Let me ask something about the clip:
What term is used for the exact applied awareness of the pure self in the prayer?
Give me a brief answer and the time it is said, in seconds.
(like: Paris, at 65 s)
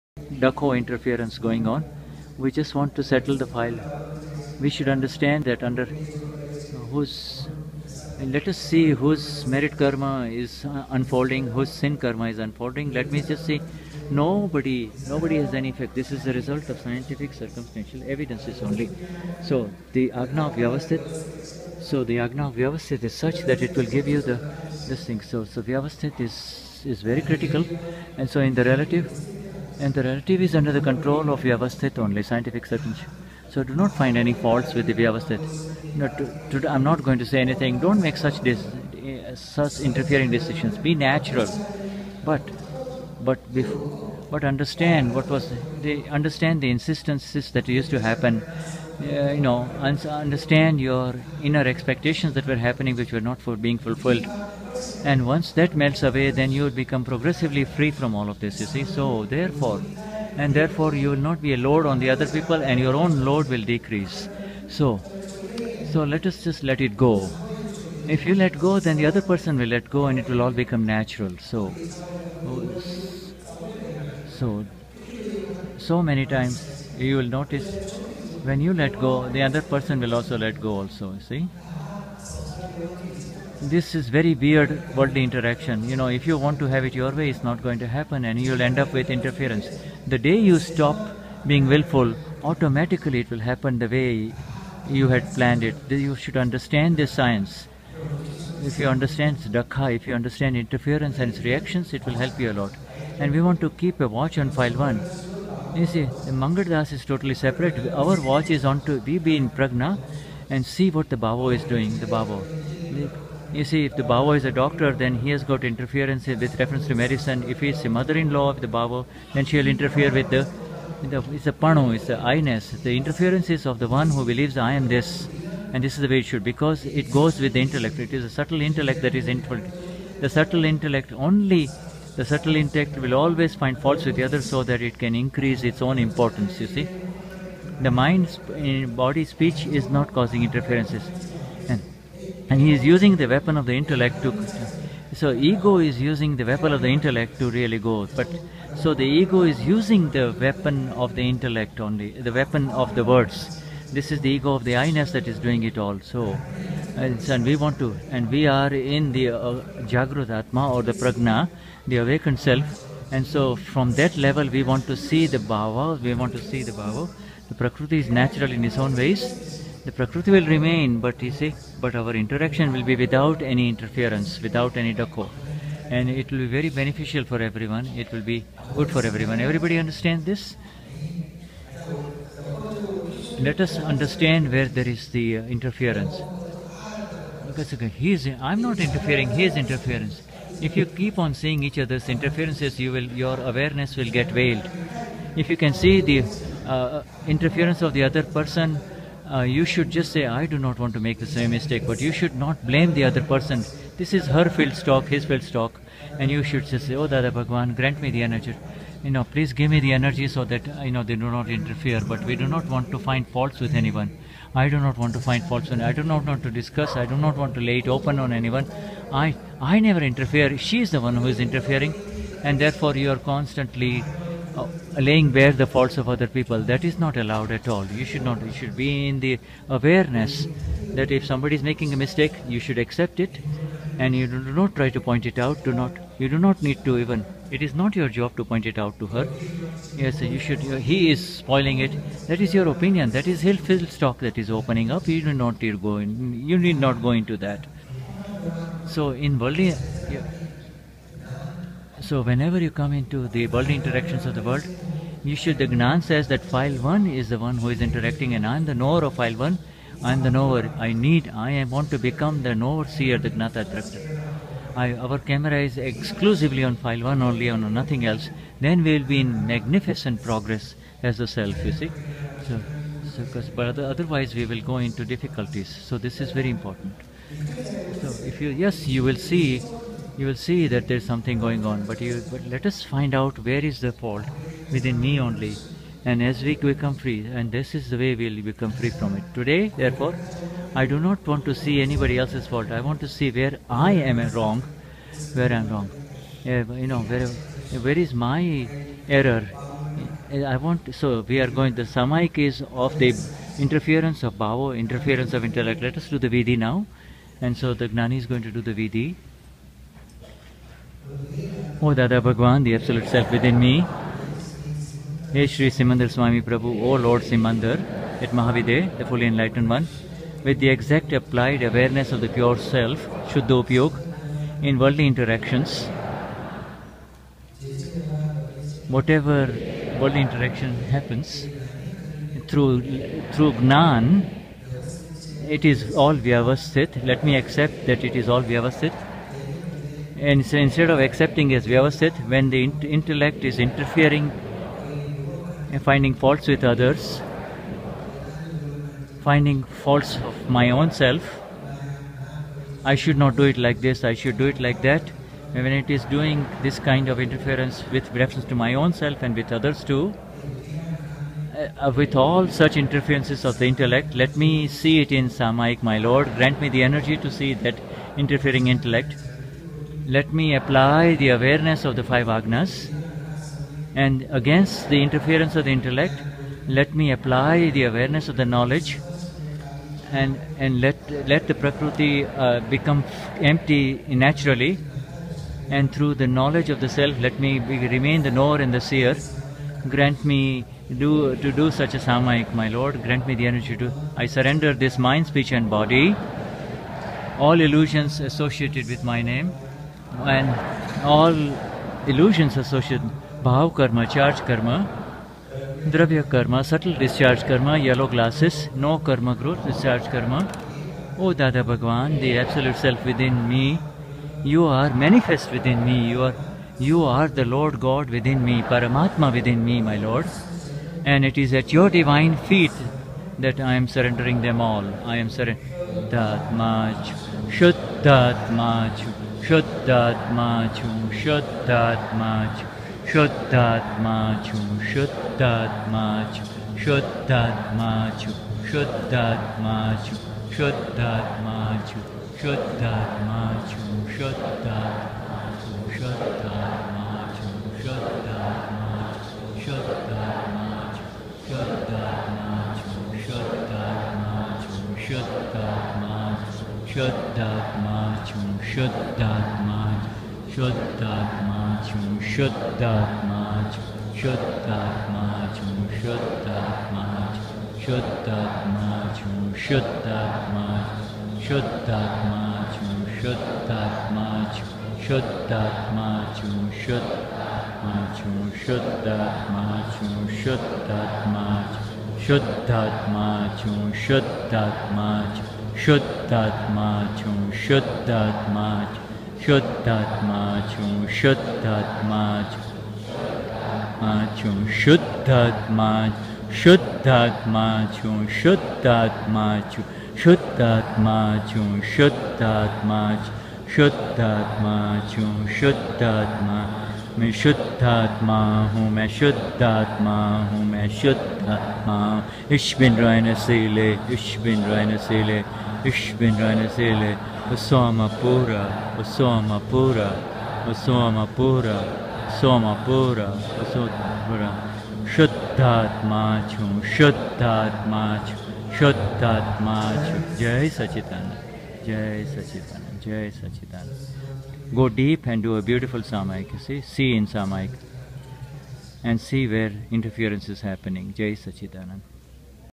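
Shuddhopayog, at 323 s.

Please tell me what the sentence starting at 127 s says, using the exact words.
It is a subtle intellect that is involved.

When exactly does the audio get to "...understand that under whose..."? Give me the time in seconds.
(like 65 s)
4 s.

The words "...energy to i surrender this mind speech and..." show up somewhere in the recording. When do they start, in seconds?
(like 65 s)
393 s.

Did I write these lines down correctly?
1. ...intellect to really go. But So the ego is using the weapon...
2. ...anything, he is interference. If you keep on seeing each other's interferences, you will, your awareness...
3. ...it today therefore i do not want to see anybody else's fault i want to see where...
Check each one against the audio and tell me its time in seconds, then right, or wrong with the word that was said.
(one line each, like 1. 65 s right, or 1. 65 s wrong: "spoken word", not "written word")
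1. 146 s right
2. 188 s wrong: "interfering", not "anything"
3. 289 s right.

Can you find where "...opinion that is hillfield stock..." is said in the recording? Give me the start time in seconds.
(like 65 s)
242 s.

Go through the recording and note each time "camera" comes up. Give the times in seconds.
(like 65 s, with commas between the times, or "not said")
265 s.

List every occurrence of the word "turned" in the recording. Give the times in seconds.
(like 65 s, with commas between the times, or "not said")
not said.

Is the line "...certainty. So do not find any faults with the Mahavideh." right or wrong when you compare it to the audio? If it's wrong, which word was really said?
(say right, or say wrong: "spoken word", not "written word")
wrong: "Vyavasthit", not "Mahavideh".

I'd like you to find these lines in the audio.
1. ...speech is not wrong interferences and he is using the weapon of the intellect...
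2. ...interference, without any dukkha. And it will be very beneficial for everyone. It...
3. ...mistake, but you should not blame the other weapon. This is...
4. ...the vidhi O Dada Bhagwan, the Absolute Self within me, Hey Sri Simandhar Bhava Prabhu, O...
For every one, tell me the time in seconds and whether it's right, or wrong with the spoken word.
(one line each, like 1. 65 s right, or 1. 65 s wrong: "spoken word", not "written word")
1. 139 s wrong: "causing", not "wrong"
2. 173 s right
3. 201 s wrong: "person", not "weapon"
4. 308 s wrong: "Swami", not "Bhava".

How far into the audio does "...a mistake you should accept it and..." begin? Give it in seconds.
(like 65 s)
231 s.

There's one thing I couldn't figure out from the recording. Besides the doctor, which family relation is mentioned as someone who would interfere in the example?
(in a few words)
Mother-in-law.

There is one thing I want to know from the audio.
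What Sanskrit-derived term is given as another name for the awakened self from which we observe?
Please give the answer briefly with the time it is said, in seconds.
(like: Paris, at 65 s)
Jagrudatma, at 159 s.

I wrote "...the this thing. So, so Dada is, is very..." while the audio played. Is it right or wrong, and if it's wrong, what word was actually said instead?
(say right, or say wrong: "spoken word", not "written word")
wrong: "Vyavasthit", not "Dada".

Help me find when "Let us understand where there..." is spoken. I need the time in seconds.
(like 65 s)
183 s.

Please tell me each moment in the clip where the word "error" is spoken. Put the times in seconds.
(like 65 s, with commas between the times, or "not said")
299 s.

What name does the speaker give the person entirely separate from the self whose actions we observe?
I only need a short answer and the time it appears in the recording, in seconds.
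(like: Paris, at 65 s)
Mangaldas, at 106 s.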